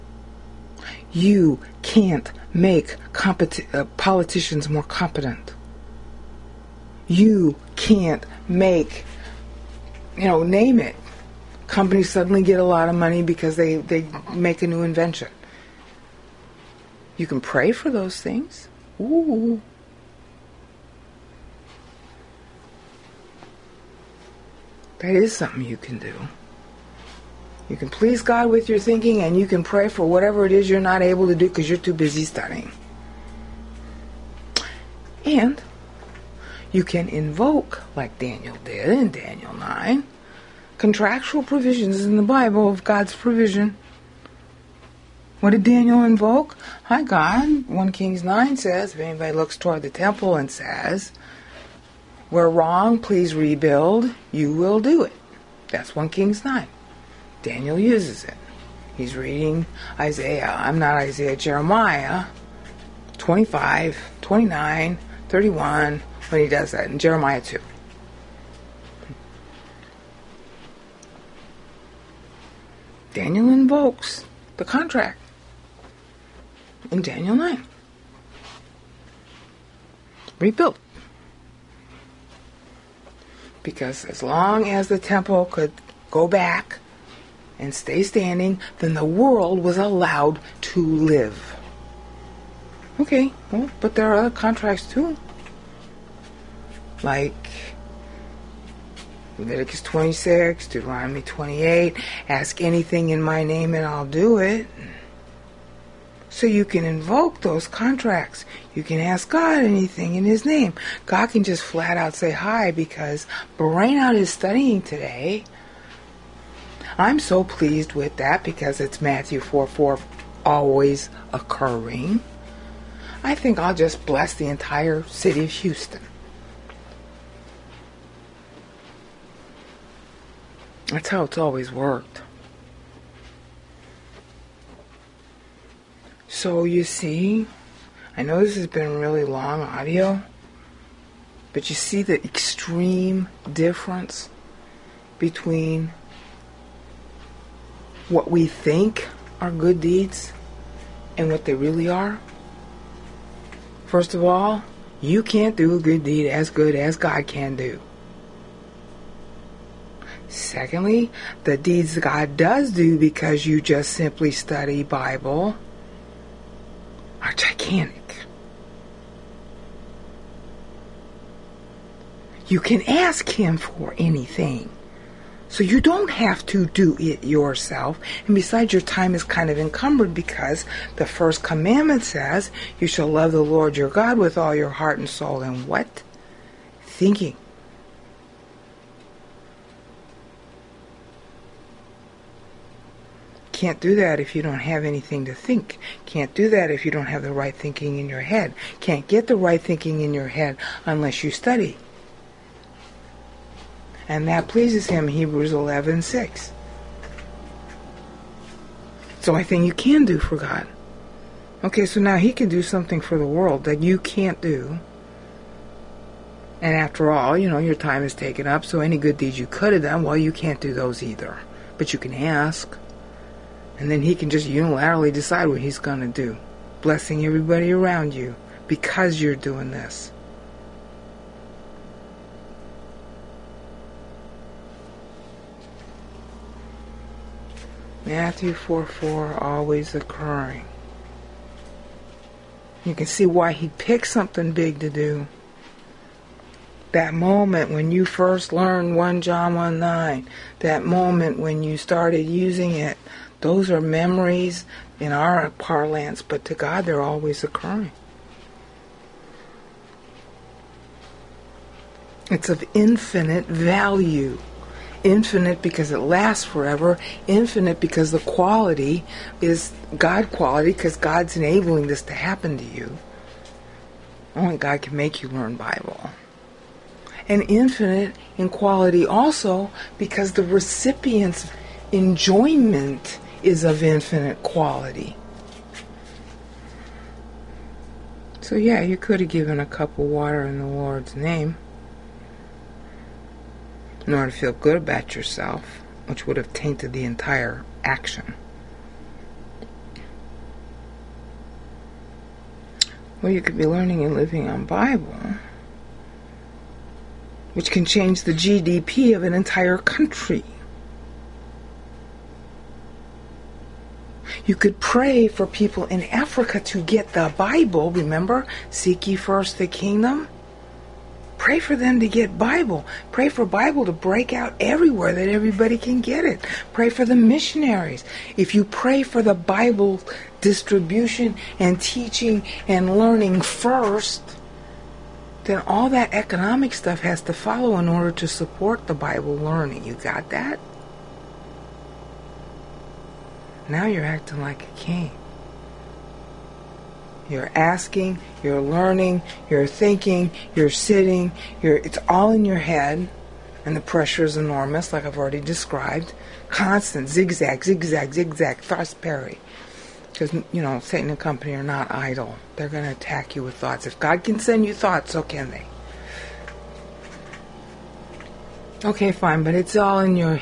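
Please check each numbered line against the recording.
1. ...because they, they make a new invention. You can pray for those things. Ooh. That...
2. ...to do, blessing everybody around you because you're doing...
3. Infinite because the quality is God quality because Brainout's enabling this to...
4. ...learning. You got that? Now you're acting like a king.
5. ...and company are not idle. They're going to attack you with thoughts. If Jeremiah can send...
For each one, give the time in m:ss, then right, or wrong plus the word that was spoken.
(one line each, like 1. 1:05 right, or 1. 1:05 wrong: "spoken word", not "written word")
1. 0:13 right
2. 3:46 right
3. 4:27 wrong: "God", not "Brainout"
4. 5:39 right
5. 6:01 wrong: "God", not "Jeremiah".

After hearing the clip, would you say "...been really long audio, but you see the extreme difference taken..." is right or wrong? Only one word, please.
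wrong.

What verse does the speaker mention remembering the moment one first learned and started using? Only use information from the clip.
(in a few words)
1 John 1:9.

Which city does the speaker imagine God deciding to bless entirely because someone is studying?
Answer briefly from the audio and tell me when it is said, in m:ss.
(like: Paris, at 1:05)
Houston, at 2:05.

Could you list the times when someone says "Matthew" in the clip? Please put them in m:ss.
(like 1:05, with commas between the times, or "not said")
1:59, 3:58.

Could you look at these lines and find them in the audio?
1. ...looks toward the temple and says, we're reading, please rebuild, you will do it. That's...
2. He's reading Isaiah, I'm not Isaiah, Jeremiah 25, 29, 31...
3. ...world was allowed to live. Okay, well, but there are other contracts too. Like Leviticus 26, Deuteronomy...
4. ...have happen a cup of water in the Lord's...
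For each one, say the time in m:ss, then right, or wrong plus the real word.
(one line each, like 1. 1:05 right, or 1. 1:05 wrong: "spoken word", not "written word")
1. 0:49 wrong: "wrong", not "reading"
2. 0:58 right
3. 1:29 right
4. 4:49 wrong: "given", not "happen".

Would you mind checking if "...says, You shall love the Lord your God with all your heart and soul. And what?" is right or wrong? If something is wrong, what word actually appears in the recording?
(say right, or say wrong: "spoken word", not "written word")
right.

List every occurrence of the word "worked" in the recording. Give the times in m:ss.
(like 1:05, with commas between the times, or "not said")
2:11.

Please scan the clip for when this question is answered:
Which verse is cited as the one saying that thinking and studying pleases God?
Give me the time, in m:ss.
3:25.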